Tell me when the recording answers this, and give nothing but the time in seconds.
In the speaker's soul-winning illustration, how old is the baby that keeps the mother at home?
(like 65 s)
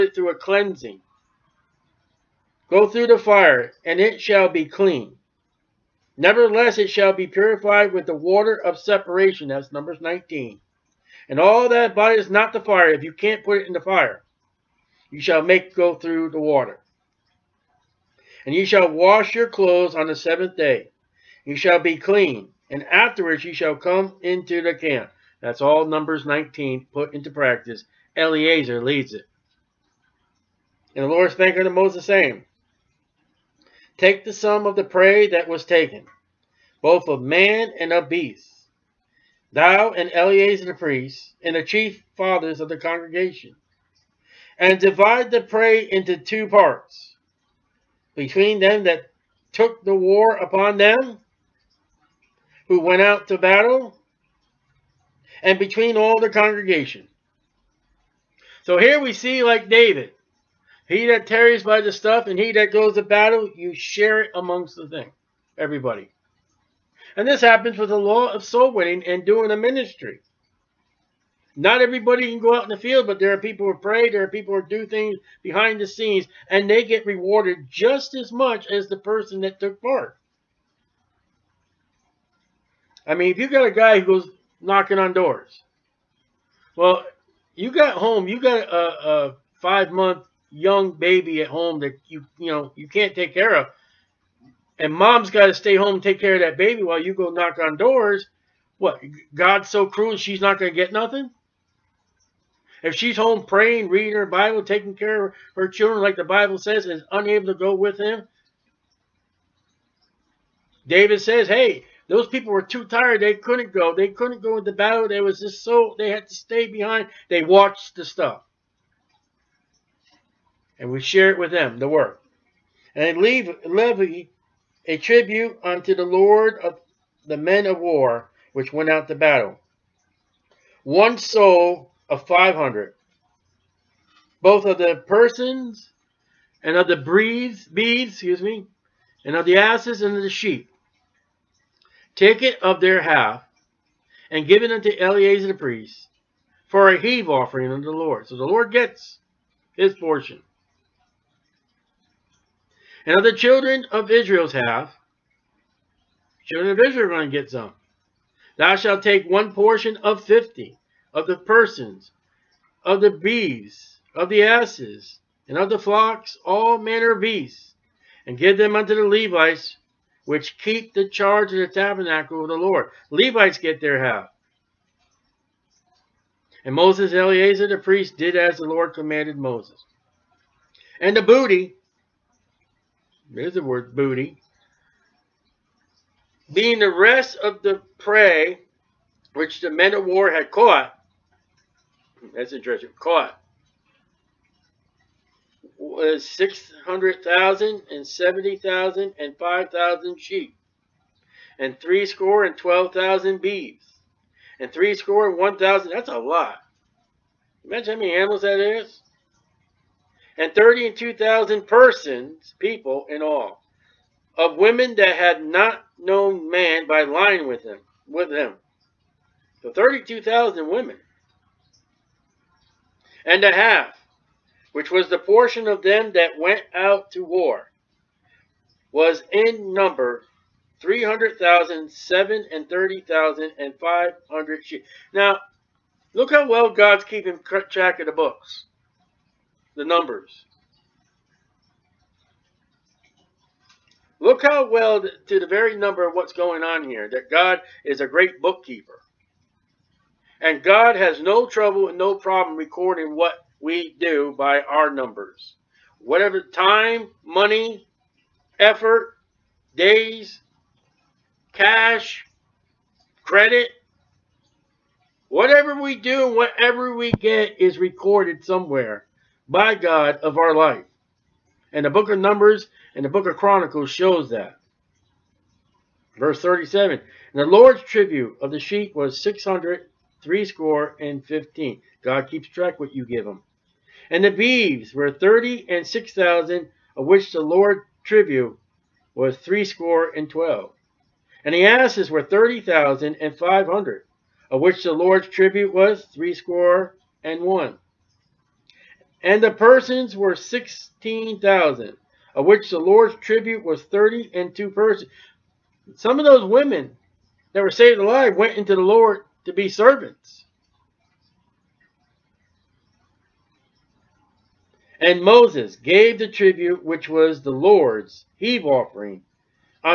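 89 s.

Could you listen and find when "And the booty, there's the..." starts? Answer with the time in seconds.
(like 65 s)
180 s.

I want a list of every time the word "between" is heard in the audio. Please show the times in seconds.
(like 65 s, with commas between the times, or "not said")
48 s, 55 s.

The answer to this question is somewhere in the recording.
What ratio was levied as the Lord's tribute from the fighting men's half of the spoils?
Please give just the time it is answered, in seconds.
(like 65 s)
130 s.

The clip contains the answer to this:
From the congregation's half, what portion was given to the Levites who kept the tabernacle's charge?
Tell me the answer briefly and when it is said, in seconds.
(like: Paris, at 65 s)
1 of 50, at 159 s.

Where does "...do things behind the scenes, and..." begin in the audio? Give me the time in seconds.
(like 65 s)
74 s.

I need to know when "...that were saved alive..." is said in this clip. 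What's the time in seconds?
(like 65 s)
307 s.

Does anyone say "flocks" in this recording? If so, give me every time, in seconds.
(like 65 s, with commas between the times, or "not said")
165 s.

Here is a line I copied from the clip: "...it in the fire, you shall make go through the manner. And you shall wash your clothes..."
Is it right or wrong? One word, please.
wrong.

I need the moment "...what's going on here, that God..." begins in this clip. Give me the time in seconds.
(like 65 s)
246 s.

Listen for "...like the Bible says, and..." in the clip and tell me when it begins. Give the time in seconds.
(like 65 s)
105 s.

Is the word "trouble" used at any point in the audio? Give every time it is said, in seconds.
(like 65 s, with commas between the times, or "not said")
251 s.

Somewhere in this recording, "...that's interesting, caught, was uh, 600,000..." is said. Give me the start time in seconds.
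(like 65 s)
192 s.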